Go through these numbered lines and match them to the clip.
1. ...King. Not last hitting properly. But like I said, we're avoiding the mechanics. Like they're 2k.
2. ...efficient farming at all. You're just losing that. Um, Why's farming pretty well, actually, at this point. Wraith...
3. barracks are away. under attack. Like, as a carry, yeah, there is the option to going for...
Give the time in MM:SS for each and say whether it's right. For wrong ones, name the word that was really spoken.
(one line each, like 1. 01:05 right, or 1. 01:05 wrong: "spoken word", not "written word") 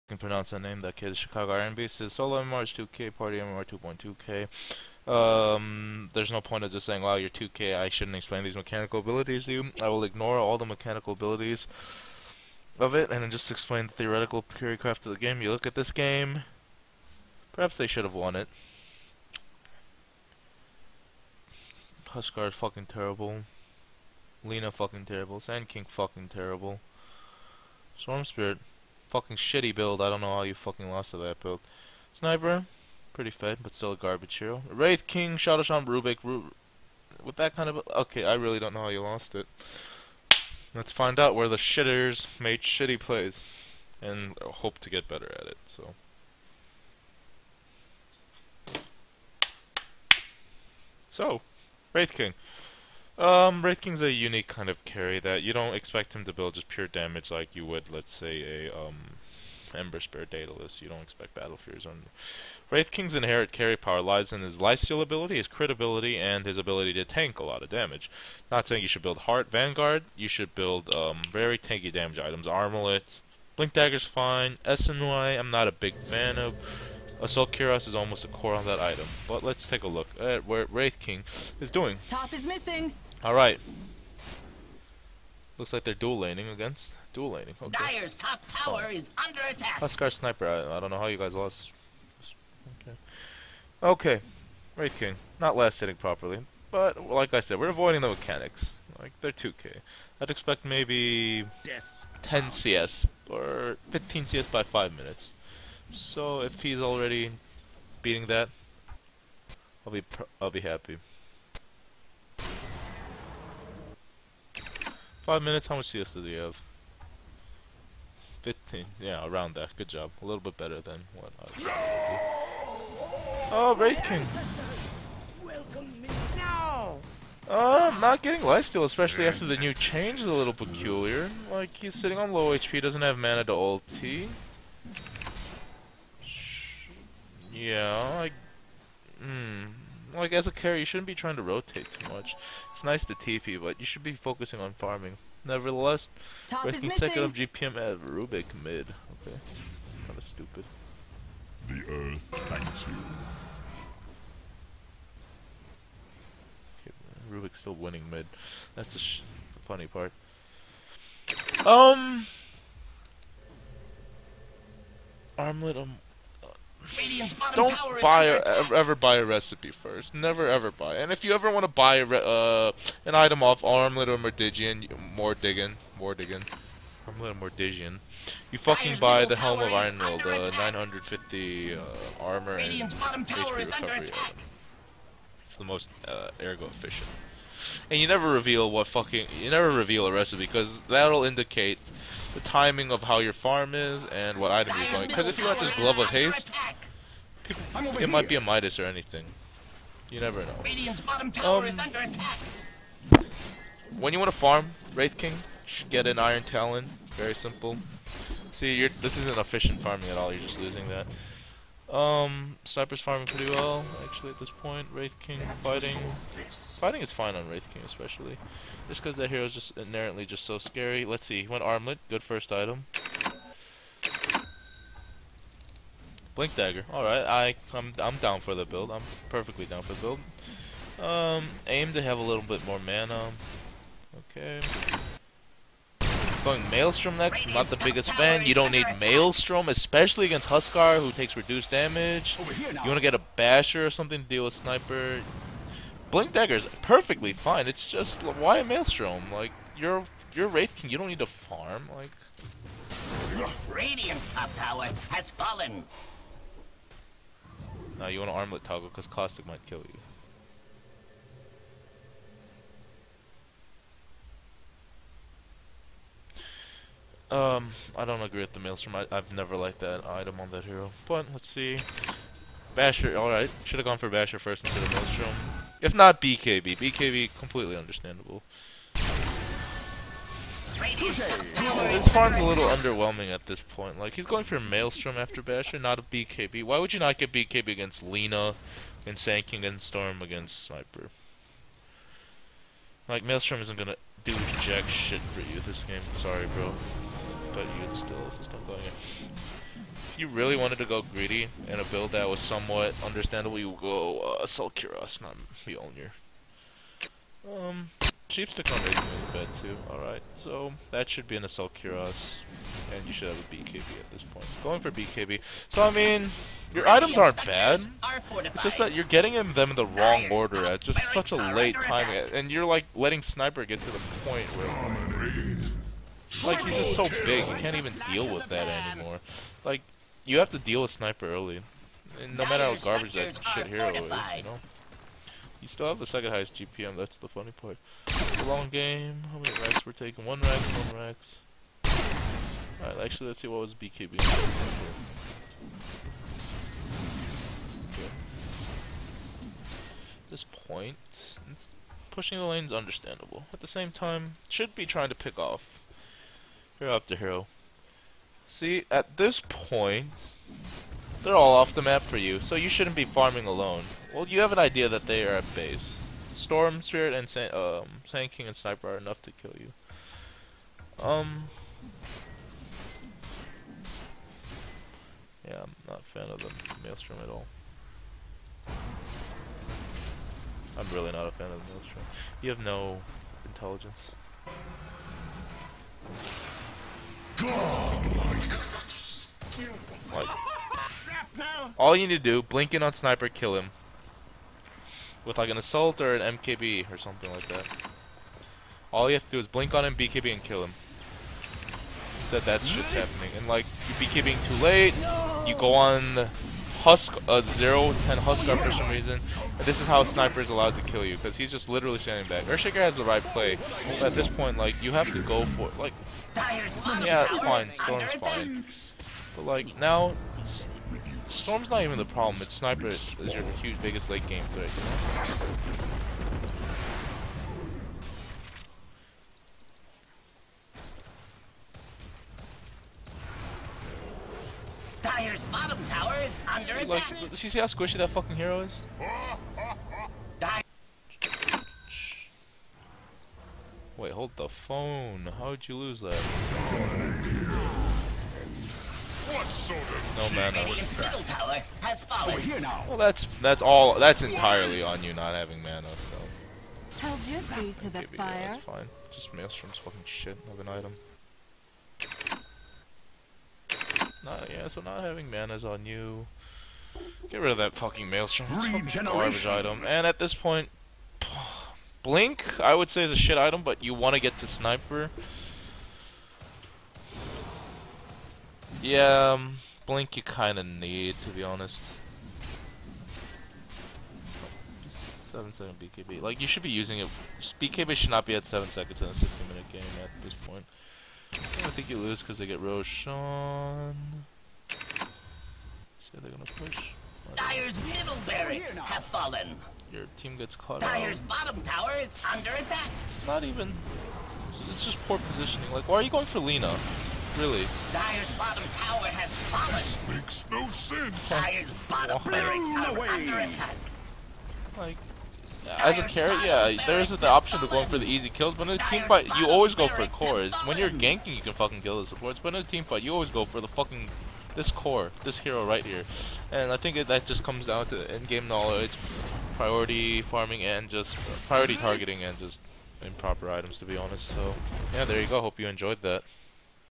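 1. 01:34 right
2. 03:29 wrong: "Sniper", not "Why"
3. 08:32 right.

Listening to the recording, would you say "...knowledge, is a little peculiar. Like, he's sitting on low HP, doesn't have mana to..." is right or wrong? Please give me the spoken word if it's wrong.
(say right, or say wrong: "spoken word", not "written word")
wrong: "change", not "knowledge".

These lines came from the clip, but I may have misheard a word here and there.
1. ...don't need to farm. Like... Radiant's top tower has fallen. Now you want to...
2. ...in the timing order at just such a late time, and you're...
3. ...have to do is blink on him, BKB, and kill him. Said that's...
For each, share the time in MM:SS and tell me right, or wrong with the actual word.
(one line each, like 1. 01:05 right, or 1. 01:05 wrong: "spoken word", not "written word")
1. 04:10 right
2. 05:19 wrong: "wrong", not "timing"
3. 06:39 right.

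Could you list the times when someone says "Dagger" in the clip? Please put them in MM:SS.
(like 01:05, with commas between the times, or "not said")
01:13, 03:46, 04:06.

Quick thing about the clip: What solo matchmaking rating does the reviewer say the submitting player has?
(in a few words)
2K.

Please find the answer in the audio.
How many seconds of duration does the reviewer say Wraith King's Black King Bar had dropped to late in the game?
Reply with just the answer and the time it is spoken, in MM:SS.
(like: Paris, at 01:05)
7, at 08:05.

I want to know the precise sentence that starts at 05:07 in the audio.
Um, cheap stick on Racing is a bit too, alright.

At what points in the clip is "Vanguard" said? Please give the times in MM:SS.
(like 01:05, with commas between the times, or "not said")
01:09.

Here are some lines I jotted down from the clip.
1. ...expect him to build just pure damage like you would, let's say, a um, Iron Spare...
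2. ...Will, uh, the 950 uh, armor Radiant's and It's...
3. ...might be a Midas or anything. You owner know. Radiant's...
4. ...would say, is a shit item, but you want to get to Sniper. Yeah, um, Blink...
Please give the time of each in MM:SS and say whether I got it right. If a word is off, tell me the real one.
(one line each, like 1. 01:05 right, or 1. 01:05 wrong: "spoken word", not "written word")
1. 00:55 wrong: "Ember", not "Iron"
2. 02:59 right
3. 03:18 wrong: "never", not "owner"
4. 07:52 right.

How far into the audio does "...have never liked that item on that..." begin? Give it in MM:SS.
04:29.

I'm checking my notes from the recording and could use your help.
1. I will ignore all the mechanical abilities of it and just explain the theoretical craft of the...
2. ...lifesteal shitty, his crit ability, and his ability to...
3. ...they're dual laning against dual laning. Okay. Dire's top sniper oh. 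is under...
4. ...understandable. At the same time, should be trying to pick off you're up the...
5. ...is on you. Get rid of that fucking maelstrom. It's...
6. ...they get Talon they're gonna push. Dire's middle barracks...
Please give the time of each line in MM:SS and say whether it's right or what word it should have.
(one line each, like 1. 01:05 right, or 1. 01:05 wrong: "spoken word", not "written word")
1. 00:09 right
2. 01:04 wrong: "ability", not "shitty"
3. 01:25 wrong: "tower", not "sniper"
4. 05:52 right
5. 07:45 right
6. 08:12 wrong: "Roshan", not "Talon".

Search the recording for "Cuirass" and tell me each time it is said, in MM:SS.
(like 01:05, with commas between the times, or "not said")
01:17, 05:11.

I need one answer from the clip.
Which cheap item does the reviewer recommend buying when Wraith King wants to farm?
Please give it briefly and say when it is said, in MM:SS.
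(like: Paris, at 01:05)
Iron Talon, at 03:25.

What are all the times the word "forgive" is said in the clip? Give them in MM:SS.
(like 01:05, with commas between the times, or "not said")
not said.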